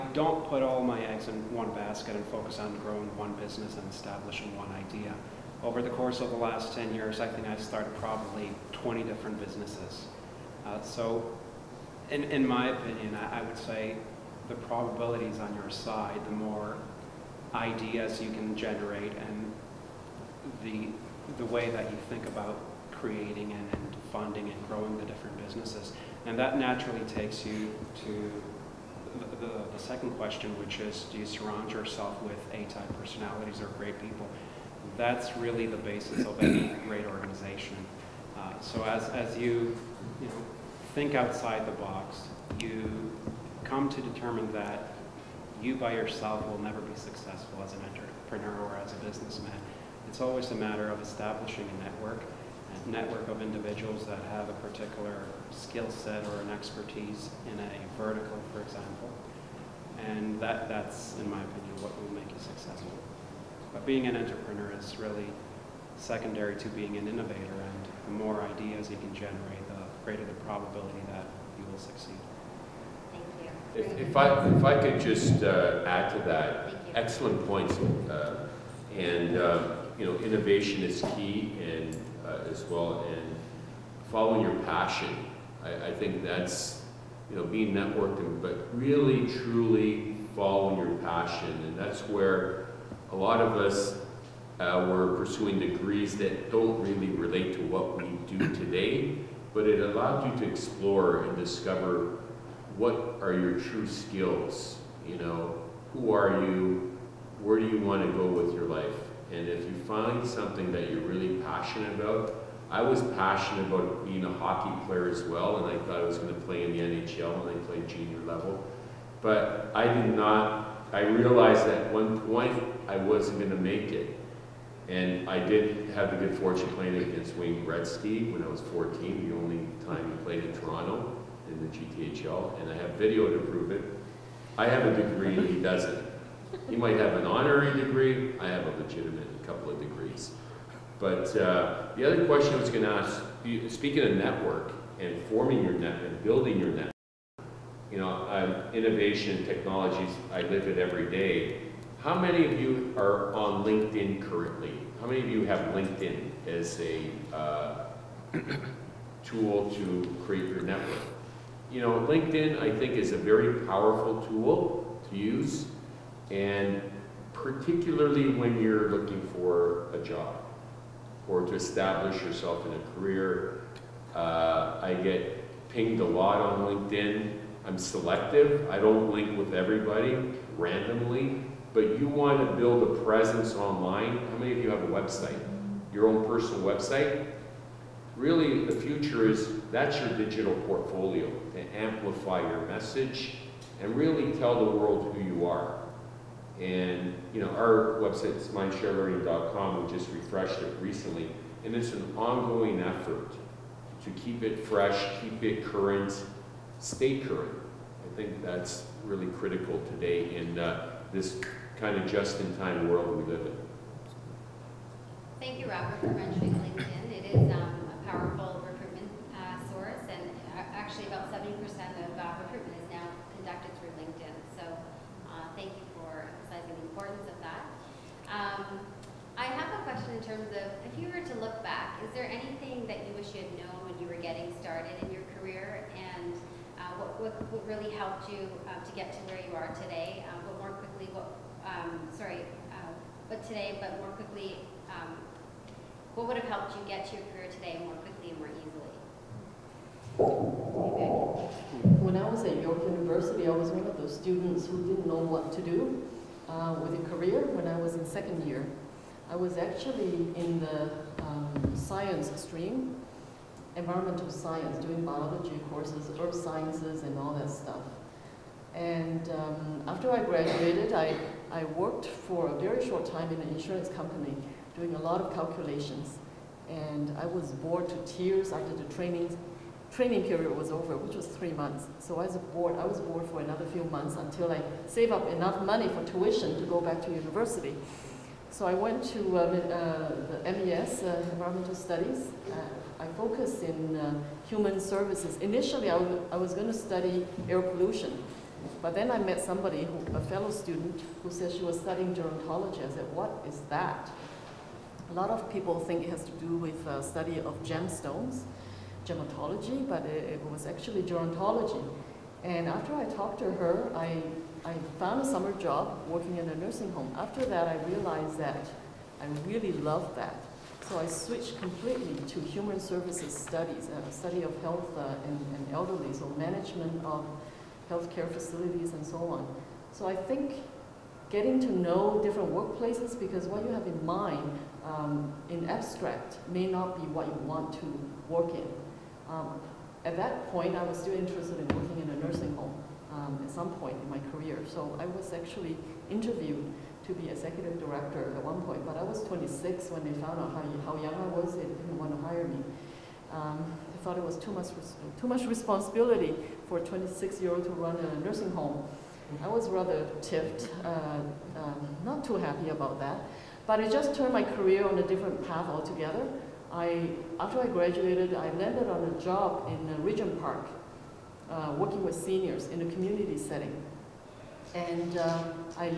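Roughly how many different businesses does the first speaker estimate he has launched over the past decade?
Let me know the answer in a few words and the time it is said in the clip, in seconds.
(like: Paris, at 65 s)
20, at 8 s.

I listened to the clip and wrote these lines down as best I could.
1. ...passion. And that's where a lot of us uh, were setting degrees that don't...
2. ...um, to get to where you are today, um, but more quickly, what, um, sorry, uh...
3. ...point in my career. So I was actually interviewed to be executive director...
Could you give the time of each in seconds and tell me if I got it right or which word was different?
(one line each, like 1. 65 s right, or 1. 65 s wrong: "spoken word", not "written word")
1. 90 s wrong: "pursuing", not "setting"
2. 238 s right
3. 343 s right.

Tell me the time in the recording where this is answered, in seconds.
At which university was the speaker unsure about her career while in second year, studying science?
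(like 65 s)
252 s.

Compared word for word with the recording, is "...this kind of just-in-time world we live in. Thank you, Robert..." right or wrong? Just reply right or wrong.
right.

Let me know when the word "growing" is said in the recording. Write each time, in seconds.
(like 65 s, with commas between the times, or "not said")
2 s, 24 s.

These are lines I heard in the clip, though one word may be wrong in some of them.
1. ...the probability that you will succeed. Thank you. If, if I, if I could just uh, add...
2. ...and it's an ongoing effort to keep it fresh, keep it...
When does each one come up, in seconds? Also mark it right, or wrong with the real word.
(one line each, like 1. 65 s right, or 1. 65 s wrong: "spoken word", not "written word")
1. 70 s right
2. 201 s right.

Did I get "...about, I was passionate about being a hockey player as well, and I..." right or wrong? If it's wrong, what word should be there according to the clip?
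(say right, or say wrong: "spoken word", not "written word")
right.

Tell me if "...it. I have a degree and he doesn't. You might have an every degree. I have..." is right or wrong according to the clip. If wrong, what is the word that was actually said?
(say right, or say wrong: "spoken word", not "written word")
wrong: "honorary", not "every".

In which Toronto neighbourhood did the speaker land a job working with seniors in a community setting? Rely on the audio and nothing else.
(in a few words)
Regent Park.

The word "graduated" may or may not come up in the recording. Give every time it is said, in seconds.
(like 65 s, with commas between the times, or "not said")
270 s, 367 s.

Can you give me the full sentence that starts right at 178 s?
I don't link with everybody randomly, but you want to build a presence online.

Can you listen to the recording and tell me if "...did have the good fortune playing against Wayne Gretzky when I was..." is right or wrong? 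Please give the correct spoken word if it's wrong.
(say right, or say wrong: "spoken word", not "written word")
right.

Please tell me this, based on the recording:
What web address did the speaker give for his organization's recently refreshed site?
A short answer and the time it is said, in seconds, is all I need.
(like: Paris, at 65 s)
mindshare.learning.com, at 198 s.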